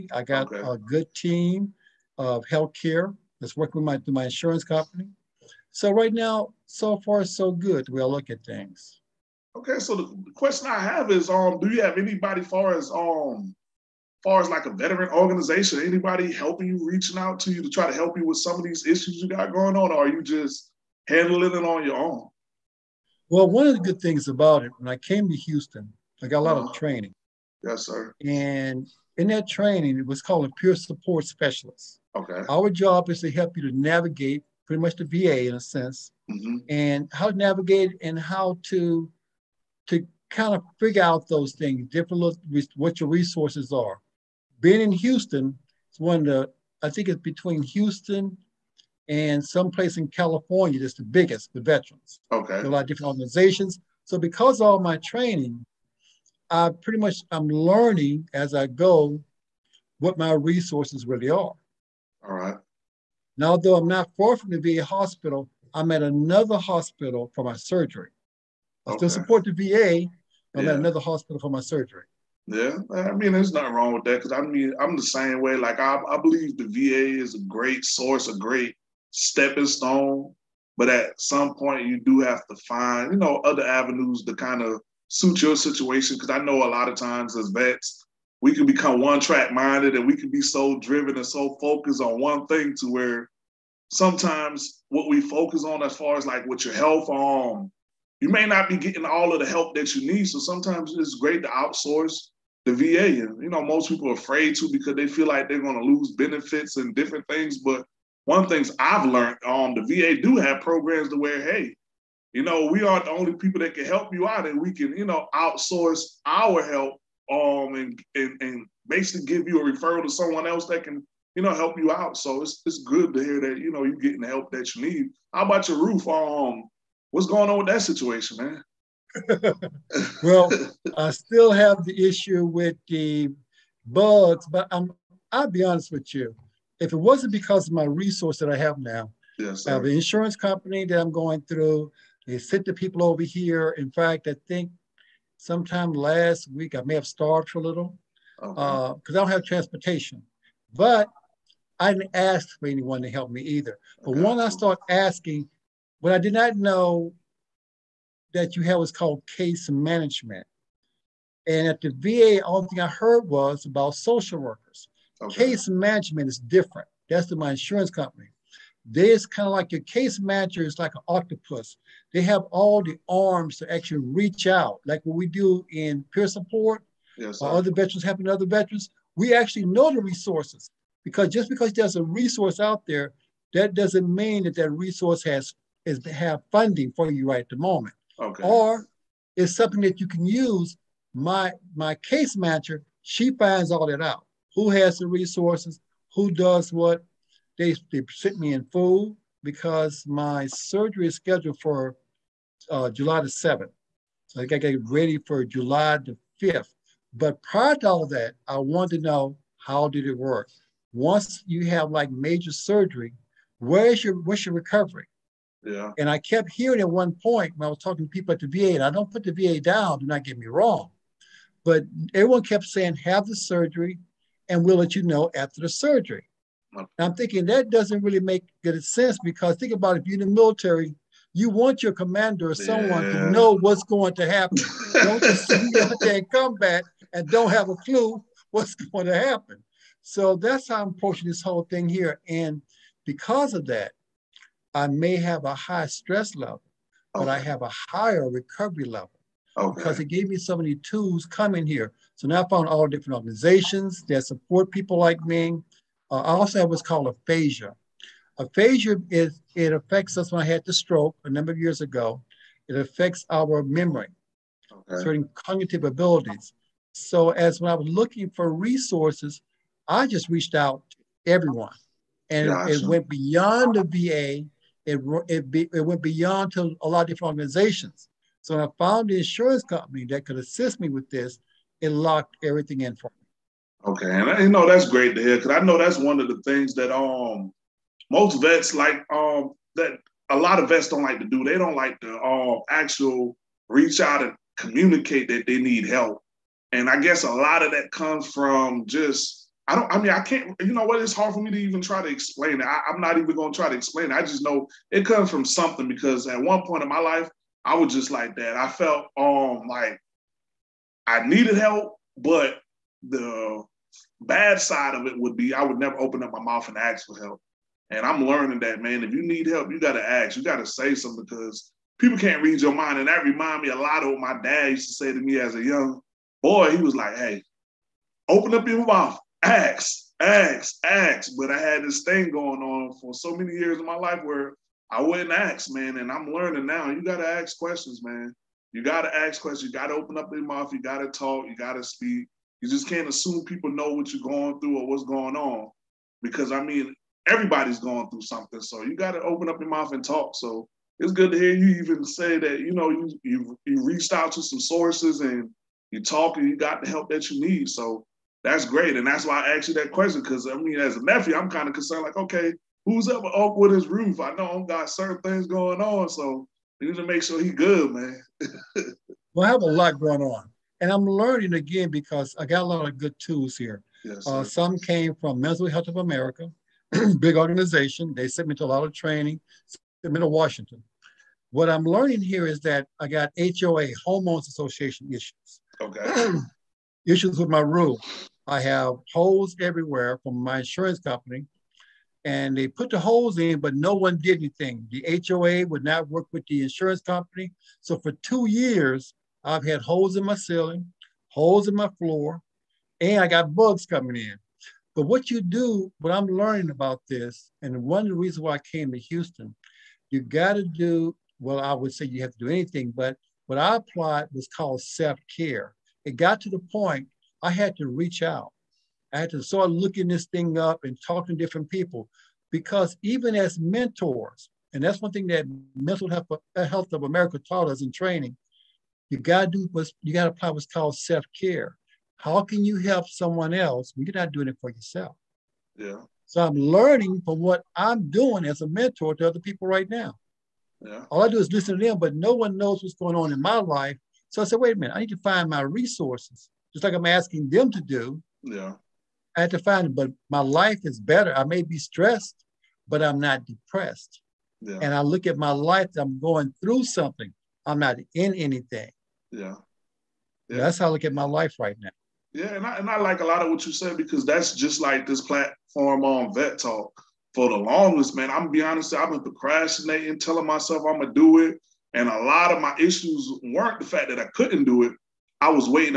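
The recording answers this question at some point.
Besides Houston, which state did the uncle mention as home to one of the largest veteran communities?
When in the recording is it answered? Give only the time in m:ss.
0:50.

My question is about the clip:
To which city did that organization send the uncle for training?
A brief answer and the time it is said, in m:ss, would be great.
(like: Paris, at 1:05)
Washington, at 6:20.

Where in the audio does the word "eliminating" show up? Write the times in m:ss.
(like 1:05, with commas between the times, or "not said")
not said.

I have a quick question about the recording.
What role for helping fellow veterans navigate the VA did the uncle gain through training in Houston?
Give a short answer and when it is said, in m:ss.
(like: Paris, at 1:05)
Peer support specialist, at 0:30.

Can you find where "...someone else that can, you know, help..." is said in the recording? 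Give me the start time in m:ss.
2:00.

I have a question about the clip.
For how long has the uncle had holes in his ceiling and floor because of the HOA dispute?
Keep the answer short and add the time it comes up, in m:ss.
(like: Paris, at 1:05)
2 years, at 6:38.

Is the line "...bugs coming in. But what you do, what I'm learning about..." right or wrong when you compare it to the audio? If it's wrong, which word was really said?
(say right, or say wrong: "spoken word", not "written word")
right.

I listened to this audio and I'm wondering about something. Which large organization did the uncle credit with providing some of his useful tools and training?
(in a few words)
Mental Health of America.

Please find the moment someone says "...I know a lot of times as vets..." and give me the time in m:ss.
1:26.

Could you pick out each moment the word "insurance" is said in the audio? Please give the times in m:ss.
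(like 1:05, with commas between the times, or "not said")
0:04, 2:19, 2:47, 4:39, 6:30, 6:36.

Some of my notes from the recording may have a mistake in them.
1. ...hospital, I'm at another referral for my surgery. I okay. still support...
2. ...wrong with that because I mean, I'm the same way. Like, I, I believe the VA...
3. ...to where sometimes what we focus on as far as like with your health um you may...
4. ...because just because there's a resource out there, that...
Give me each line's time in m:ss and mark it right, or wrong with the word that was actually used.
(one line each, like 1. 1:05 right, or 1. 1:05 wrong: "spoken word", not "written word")
1. 1:04 wrong: "hospital", not "referral"
2. 1:13 right
3. 1:32 right
4. 3:01 right.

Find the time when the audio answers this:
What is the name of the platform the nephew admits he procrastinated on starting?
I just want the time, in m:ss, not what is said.
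7:46.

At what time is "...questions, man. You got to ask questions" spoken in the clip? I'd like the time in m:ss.
5:37.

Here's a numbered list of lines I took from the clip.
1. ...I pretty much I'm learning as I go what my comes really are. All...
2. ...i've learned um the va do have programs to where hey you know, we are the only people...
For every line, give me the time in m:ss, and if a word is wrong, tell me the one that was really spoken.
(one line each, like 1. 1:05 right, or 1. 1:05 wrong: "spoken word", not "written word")
1. 0:56 wrong: "resources", not "comes"
2. 1:48 right.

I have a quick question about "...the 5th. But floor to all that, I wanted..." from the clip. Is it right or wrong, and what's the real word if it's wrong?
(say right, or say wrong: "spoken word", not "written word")
wrong: "prior", not "floor".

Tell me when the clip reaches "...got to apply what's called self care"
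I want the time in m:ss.
7:10.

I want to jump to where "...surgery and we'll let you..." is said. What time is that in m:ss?
3:43.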